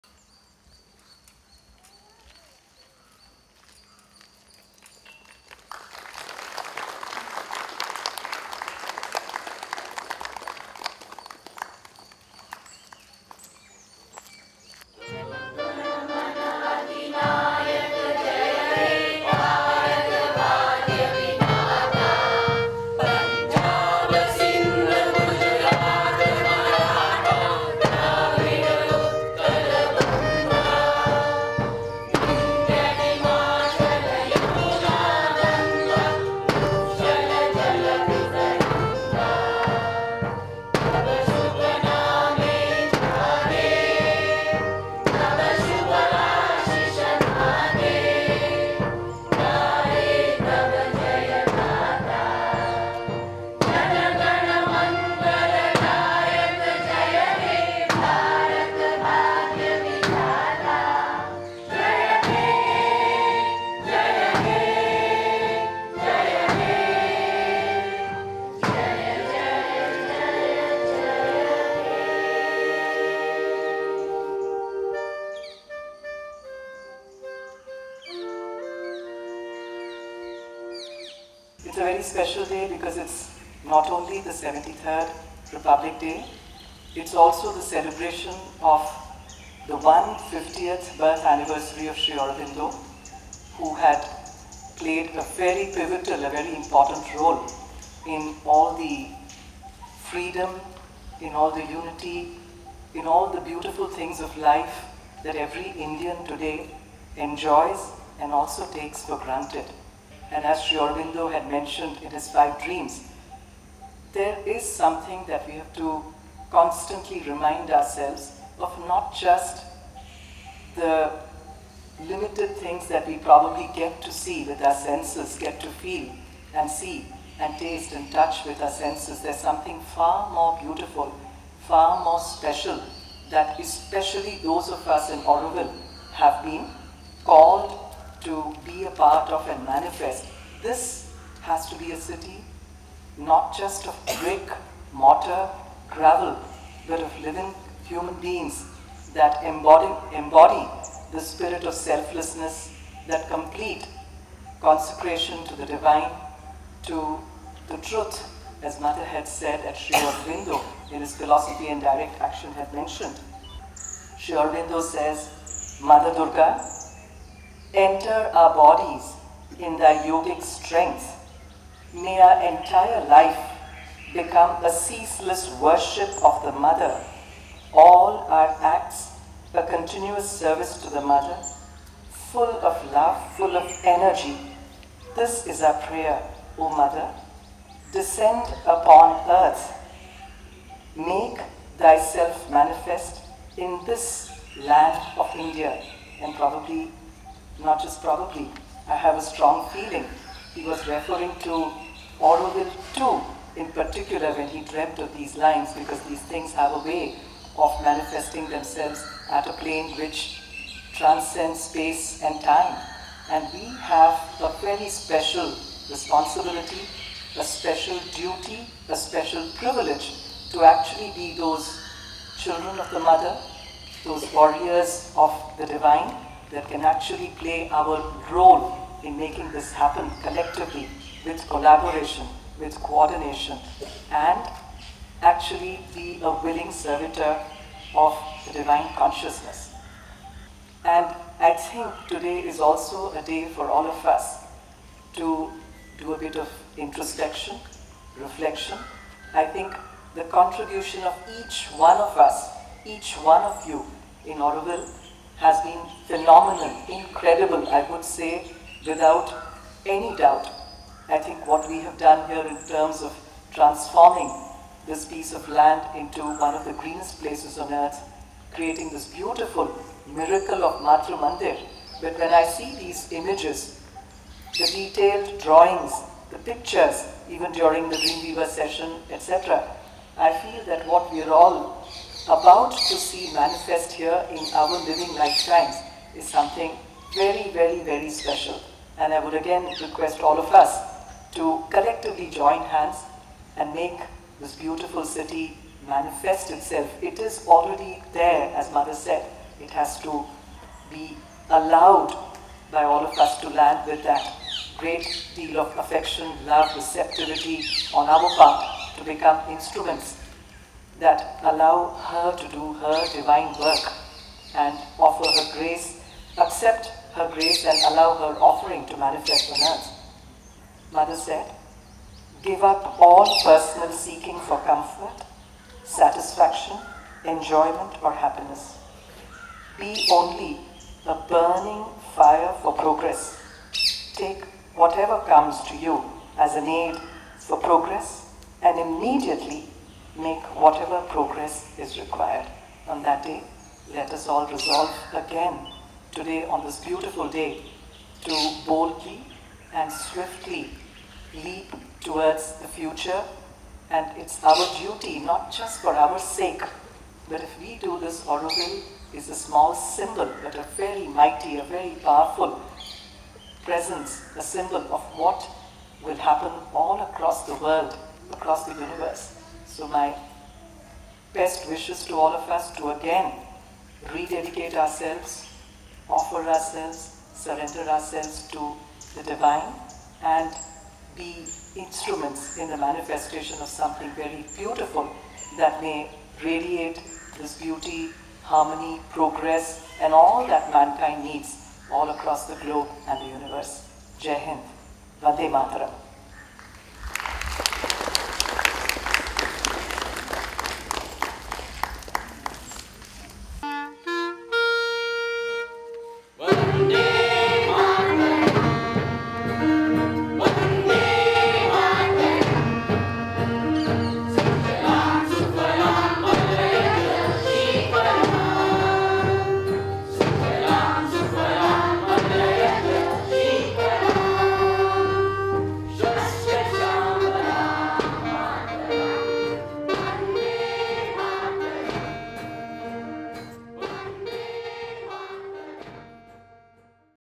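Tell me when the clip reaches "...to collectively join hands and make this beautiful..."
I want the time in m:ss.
4:51.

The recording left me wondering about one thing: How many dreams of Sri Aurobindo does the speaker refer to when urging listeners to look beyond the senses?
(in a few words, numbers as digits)
5.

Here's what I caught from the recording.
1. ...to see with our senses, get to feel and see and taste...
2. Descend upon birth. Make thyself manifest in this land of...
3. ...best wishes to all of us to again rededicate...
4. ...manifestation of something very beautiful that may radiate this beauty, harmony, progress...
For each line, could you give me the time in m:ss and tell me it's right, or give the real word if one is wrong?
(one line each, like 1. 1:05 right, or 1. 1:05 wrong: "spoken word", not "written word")
1. 2:04 right
2. 3:07 wrong: "earth", not "birth"
3. 6:11 right
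4. 6:22 right.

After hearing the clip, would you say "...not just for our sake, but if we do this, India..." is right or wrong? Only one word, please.
wrong.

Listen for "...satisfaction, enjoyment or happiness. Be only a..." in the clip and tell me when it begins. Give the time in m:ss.
5:25.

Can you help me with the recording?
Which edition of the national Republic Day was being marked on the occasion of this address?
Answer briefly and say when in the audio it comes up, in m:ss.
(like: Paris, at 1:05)
73rd, at 1:24.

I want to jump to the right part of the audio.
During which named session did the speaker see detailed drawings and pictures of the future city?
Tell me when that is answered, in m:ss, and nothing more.
4:37.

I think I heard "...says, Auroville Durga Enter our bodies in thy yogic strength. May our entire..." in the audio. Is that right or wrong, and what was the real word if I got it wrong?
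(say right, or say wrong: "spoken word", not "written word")
wrong: "Mother", not "Auroville".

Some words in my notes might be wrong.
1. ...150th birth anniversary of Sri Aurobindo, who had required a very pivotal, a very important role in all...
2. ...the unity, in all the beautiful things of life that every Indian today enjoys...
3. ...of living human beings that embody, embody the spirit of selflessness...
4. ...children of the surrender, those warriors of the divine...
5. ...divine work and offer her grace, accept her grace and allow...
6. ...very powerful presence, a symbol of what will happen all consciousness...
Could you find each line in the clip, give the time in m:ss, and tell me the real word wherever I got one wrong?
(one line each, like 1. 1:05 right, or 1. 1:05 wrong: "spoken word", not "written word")
1. 1:29 wrong: "played", not "required"
2. 1:41 right
3. 2:27 right
4. 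3:42 wrong: "mother", not "surrender"
5. 5:13 right
6. 6:01 wrong: "across", not "consciousness".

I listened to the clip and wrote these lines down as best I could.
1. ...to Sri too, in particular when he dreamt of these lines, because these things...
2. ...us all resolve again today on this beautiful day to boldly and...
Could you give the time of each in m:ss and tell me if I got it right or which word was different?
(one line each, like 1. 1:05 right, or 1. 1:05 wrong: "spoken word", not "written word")
1. 3:21 wrong: "Auroville", not "Sri"
2. 5:44 right.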